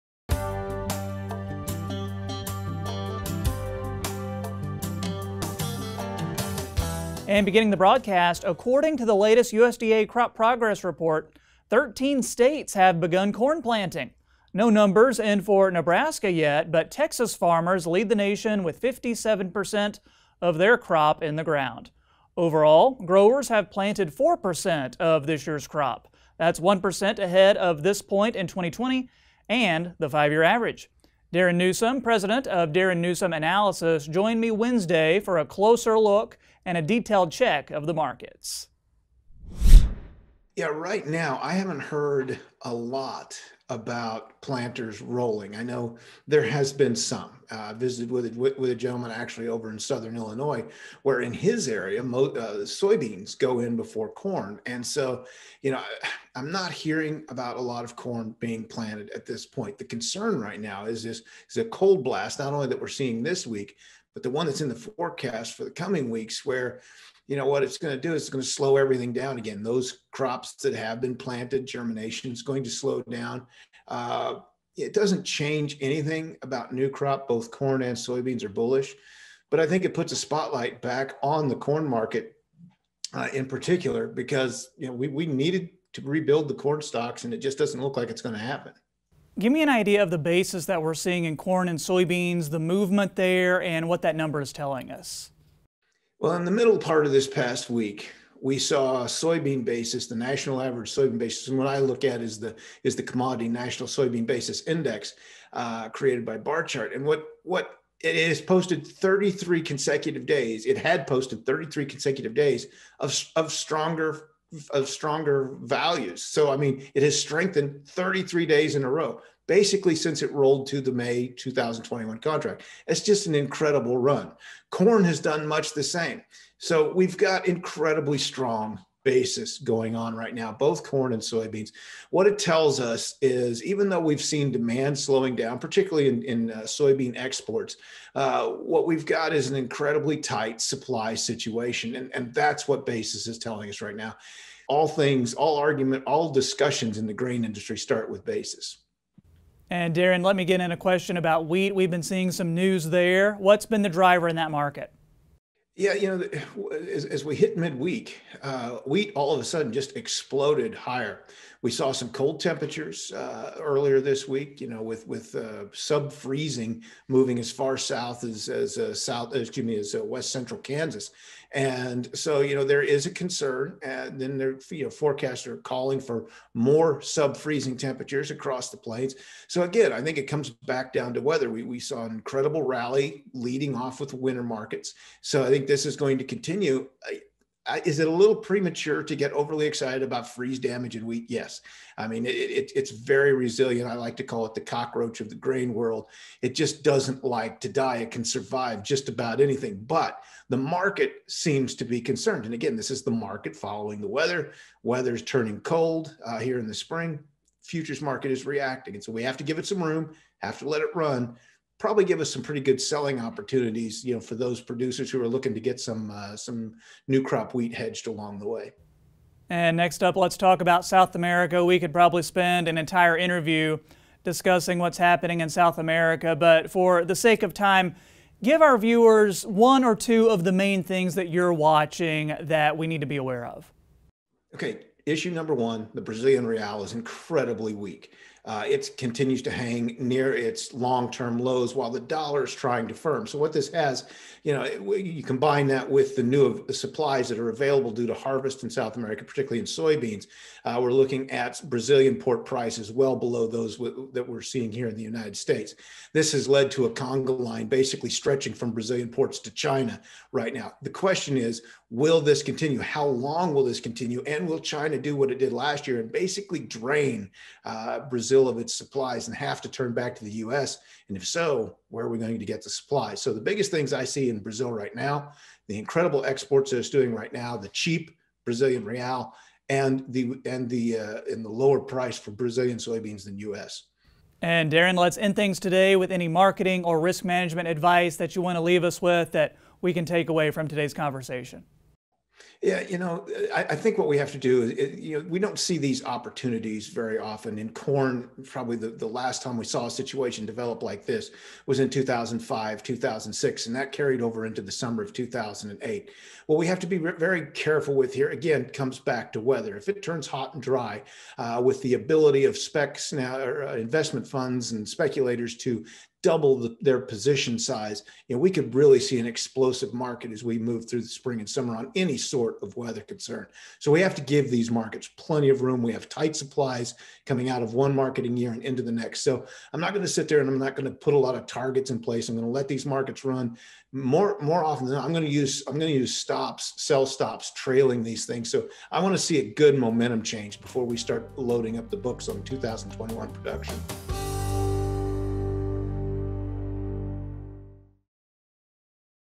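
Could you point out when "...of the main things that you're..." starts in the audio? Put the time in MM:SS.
03:50.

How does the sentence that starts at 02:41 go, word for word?
We saw some cold temperatures uh, earlier this week.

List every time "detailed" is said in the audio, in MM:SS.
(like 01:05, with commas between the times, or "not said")
00:36.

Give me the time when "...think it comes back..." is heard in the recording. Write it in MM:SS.
03:00.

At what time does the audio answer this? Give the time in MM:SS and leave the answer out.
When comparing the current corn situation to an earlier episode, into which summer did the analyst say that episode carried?
05:04.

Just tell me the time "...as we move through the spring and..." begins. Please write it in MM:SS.
05:20.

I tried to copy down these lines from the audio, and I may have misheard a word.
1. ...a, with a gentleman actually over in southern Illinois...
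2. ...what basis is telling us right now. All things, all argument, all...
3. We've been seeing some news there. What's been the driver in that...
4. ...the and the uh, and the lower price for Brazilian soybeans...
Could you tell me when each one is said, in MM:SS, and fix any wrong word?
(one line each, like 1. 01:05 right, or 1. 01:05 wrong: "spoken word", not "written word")
1. 00:48 right
2. 02:22 right
3. 02:31 right
4. 04:40 right.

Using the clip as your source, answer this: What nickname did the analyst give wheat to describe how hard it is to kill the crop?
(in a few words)
the cockroach of the grain world.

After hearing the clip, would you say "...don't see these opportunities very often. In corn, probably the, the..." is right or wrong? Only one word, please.
right.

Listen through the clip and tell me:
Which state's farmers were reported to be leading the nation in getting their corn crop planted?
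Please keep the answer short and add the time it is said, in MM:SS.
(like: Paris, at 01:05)
Texas, at 00:16.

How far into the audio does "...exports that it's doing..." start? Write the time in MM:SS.
04:36.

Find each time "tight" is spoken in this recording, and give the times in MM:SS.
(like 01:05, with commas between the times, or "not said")
02:20, 05:26.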